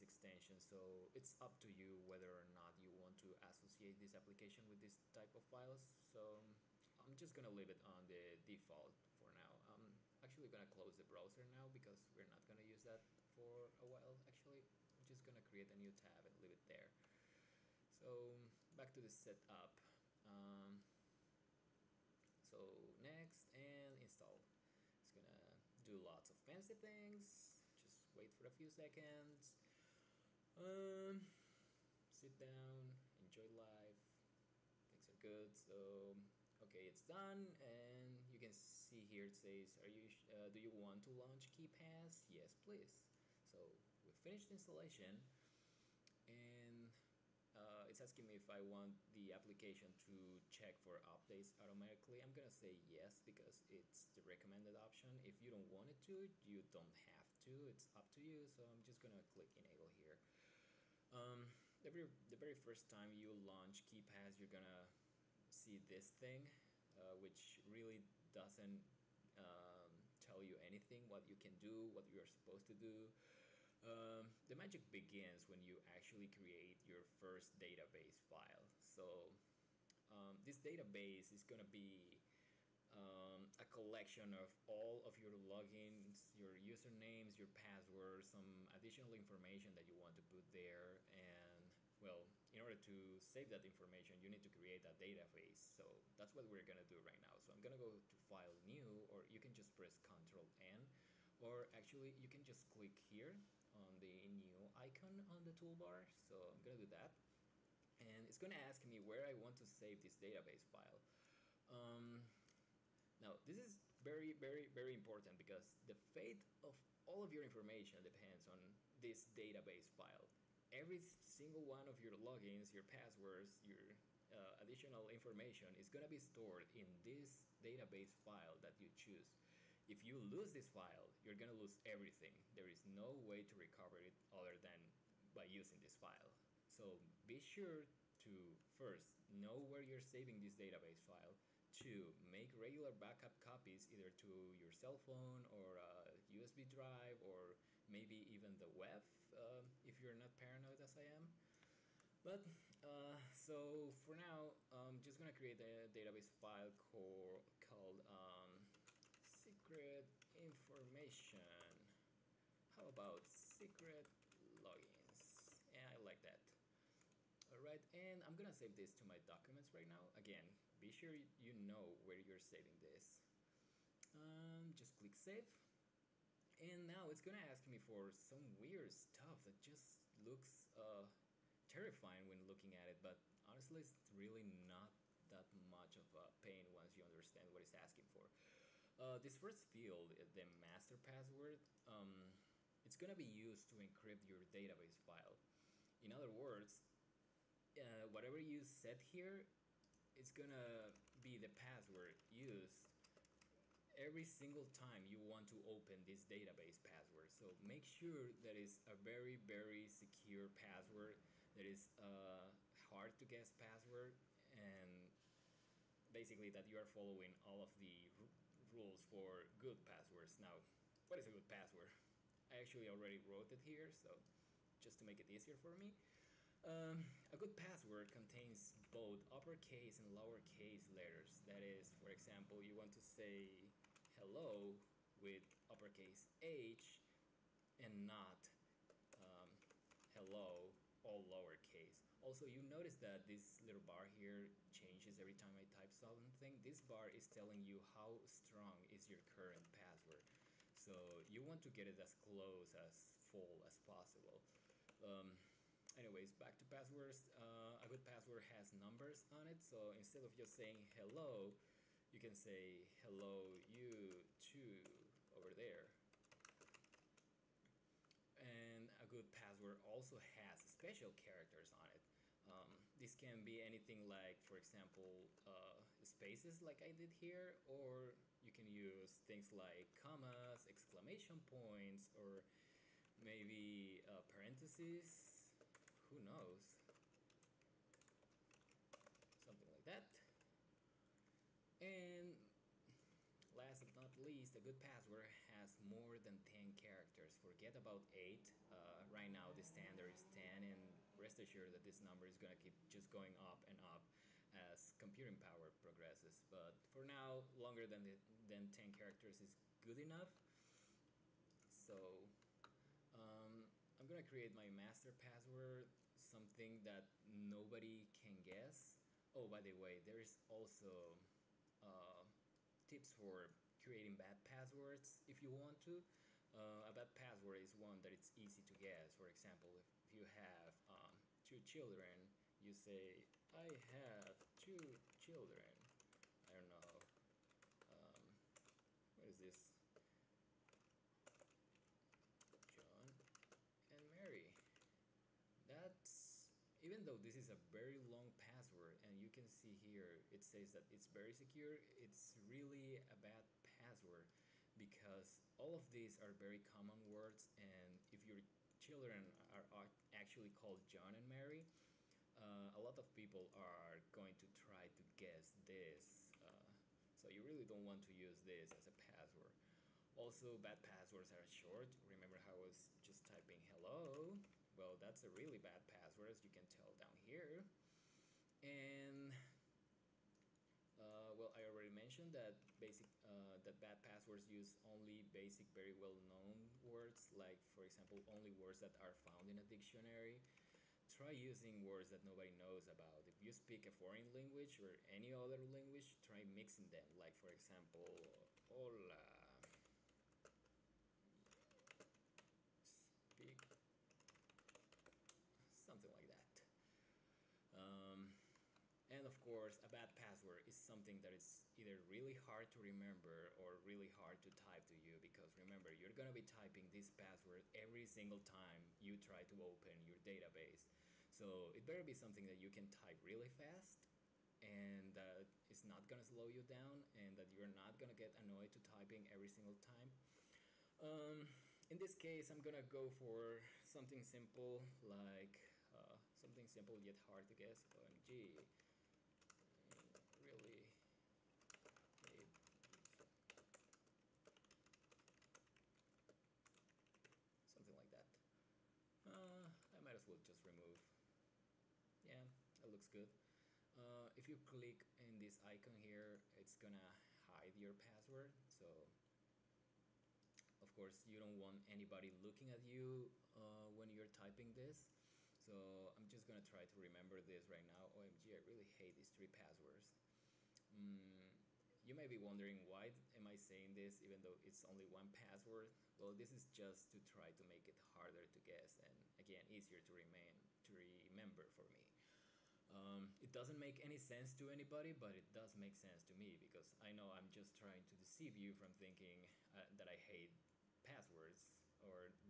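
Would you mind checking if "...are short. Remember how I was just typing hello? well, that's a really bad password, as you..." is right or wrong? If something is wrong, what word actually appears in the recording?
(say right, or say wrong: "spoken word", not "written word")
right.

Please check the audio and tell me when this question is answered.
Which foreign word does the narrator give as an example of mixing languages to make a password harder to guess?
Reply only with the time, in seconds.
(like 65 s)
398 s.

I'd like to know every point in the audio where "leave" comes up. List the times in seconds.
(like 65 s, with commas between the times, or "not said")
7 s, 16 s.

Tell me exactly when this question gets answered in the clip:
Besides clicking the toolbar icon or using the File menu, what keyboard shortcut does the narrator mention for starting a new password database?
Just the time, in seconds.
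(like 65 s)
100 s.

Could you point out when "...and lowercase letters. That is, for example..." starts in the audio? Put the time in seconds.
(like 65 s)
229 s.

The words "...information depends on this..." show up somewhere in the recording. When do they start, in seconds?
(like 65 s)
117 s.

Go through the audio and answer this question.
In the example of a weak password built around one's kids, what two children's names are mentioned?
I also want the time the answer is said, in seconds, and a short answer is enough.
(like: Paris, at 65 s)
John and Mary, at 360 s.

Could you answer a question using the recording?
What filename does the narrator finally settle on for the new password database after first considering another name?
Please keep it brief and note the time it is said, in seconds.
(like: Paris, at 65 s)
secret logins, at 163 s.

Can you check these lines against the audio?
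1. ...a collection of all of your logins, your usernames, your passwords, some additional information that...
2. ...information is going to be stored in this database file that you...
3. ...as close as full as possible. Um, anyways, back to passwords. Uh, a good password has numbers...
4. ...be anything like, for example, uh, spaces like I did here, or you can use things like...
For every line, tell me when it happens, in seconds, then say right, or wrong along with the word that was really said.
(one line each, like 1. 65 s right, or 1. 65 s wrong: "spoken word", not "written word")
1. 83 s right
2. 125 s right
3. 251 s right
4. 273 s right.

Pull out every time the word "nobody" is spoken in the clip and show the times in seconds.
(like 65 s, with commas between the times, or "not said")
317 s, 392 s.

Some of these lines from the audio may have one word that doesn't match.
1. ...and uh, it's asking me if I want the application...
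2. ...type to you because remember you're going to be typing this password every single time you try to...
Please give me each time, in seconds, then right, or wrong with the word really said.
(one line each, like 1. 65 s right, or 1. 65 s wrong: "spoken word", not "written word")
1. 46 s right
2. 414 s right.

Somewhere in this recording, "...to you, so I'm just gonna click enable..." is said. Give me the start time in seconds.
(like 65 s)
58 s.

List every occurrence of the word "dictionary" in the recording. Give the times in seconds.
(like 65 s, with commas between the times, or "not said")
389 s.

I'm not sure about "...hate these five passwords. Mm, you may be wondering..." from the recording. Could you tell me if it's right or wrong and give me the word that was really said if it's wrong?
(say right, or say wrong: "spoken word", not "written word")
wrong: "three", not "five".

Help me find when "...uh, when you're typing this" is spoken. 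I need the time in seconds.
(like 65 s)
463 s.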